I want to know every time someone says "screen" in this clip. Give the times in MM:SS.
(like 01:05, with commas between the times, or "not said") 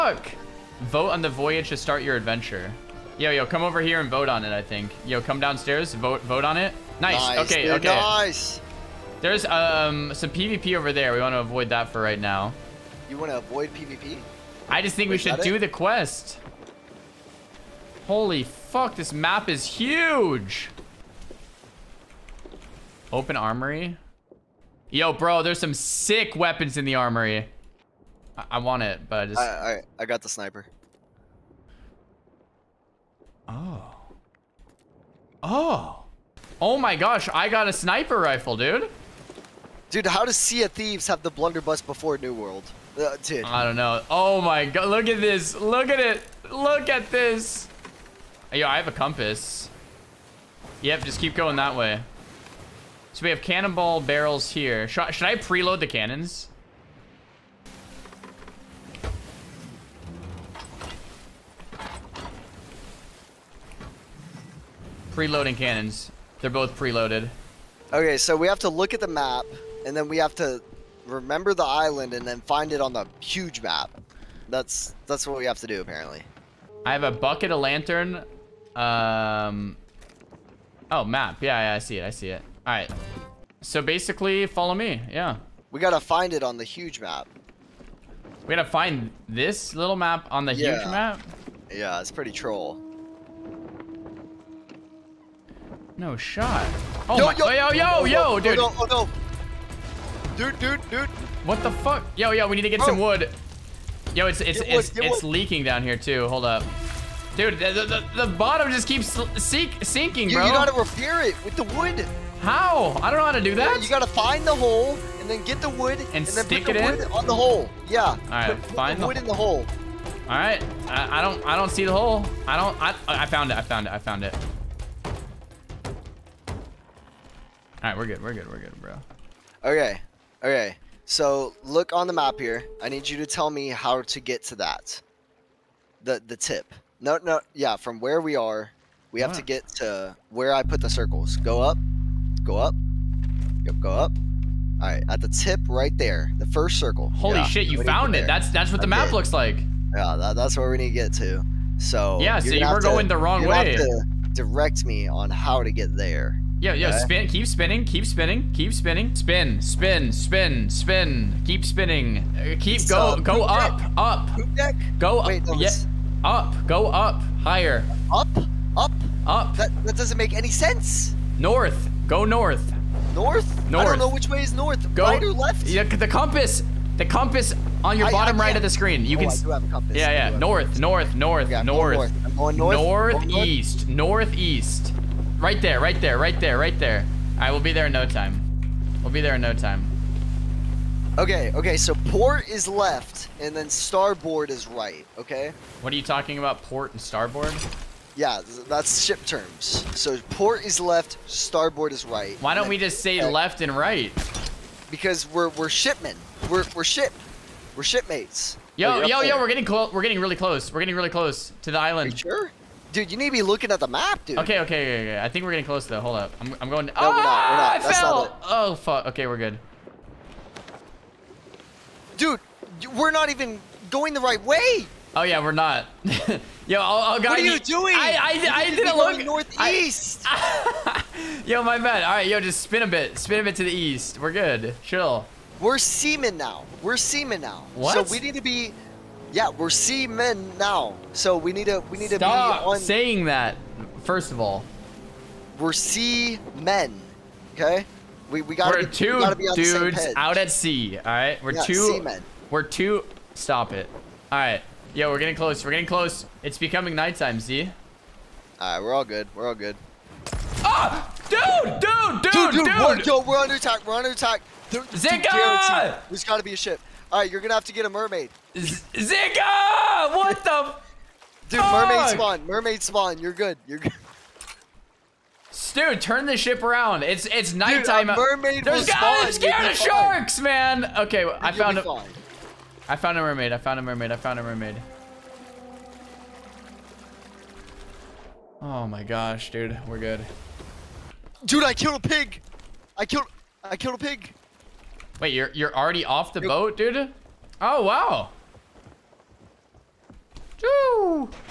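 02:58.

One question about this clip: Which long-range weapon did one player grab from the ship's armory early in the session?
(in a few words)
Sniper rifle.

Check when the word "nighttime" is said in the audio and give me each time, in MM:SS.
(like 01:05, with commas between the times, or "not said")
04:16, 04:37.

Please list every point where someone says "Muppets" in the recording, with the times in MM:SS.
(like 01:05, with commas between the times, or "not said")
not said.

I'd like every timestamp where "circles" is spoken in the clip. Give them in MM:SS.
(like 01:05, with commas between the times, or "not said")
02:20, 02:26.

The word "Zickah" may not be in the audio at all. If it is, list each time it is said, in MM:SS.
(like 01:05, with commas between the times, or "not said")
04:24, 04:28.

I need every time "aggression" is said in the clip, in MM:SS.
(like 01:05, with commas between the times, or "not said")
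not said.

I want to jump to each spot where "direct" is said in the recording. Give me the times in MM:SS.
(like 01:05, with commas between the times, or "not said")
02:34.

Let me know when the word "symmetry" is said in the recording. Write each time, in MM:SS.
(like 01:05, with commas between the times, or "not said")
not said.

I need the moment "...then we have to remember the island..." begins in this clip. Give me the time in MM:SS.
01:09.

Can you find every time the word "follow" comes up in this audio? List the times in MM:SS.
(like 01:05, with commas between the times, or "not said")
01:24.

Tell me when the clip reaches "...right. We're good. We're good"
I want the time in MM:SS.
02:07.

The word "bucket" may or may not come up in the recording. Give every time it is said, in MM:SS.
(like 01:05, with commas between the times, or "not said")
01:17.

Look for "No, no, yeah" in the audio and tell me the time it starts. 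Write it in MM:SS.
02:17.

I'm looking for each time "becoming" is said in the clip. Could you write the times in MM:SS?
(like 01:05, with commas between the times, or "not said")
04:16.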